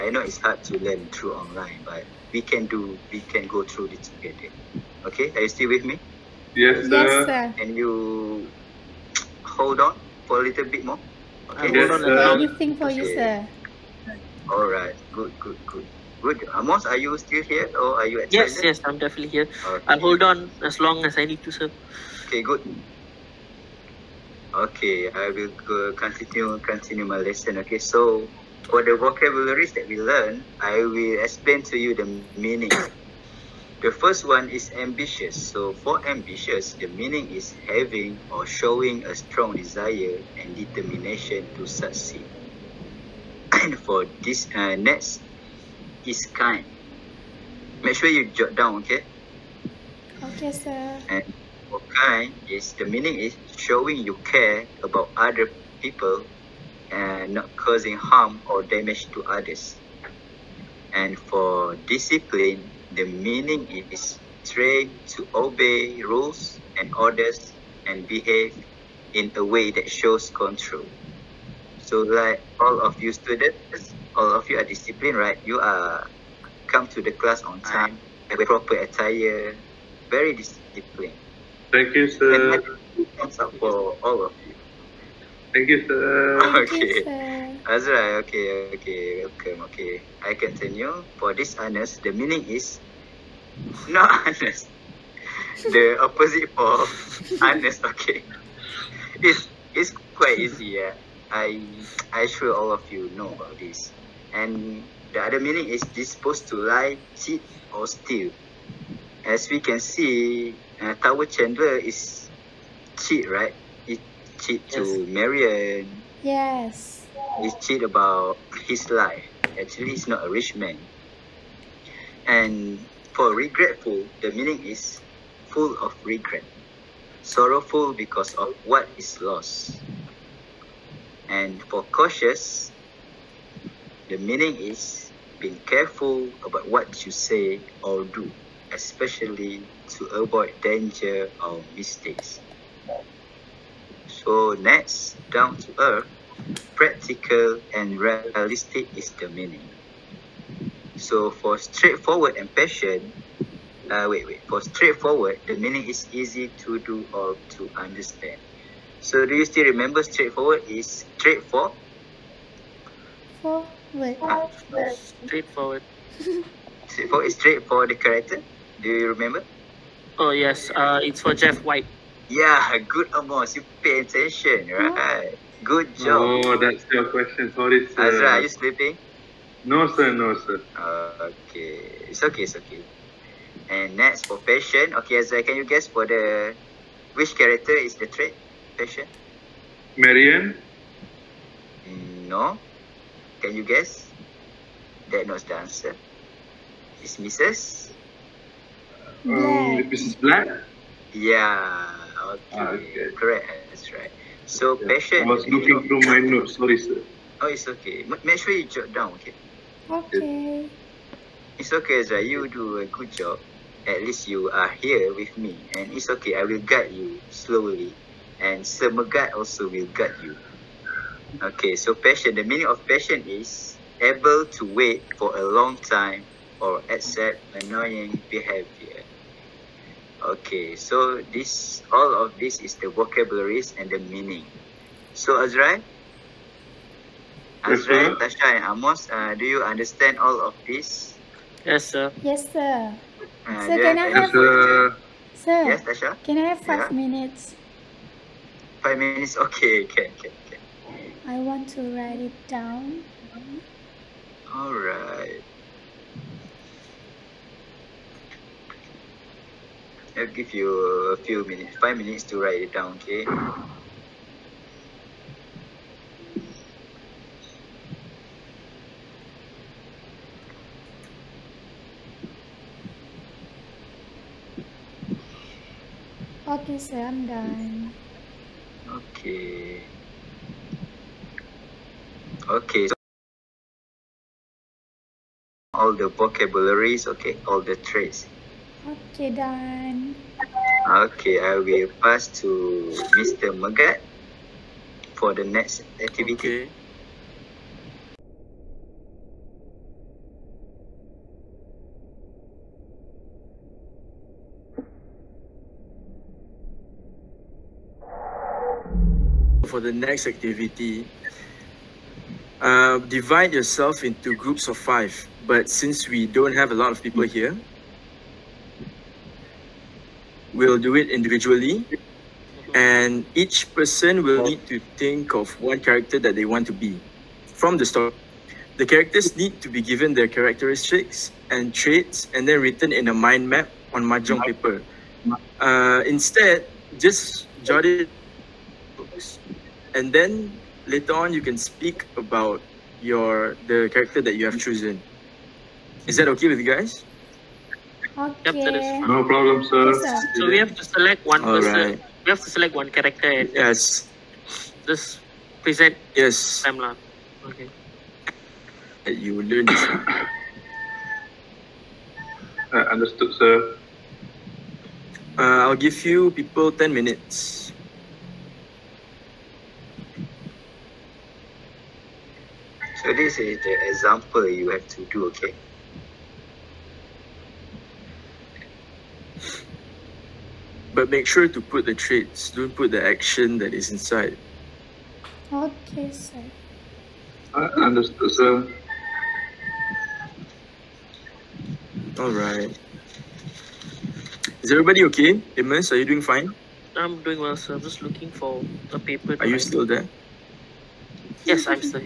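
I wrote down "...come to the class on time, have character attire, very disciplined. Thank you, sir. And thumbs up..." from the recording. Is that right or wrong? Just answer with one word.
wrong.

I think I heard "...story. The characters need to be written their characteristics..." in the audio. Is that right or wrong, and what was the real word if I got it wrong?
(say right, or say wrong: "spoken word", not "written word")
wrong: "given", not "written".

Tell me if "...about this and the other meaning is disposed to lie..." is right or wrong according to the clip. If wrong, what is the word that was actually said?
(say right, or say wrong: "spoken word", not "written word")
right.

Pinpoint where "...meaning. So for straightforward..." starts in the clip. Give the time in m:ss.
2:29.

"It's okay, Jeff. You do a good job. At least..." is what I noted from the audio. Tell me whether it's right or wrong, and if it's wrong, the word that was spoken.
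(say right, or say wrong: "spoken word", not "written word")
wrong: "Ezra", not "Jeff".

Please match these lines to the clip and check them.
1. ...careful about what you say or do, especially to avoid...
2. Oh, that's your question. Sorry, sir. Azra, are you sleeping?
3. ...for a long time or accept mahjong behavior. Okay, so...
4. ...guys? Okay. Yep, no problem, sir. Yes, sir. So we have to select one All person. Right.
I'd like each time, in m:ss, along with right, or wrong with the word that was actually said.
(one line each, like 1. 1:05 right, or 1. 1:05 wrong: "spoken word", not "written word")
1. 2:15 right
2. 2:56 right
3. 3:45 wrong: "annoying", not "mahjong"
4. 5:46 right.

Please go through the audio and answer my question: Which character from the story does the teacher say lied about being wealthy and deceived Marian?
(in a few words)
Tower Chandler.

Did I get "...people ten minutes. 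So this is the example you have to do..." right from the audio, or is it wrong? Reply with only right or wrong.
right.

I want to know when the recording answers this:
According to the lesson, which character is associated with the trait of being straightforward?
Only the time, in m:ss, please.
2:51.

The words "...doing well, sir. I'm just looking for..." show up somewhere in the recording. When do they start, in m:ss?
6:37.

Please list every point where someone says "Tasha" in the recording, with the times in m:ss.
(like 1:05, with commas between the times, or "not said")
3:58, 4:05.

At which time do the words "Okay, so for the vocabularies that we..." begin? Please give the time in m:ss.
0:27.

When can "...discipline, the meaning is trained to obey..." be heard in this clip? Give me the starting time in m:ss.
1:01.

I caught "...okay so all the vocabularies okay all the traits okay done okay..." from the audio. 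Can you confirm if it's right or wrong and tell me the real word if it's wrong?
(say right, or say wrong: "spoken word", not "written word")
right.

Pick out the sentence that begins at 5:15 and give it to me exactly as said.
But since we don't have a lot of people here, we'll do it individually.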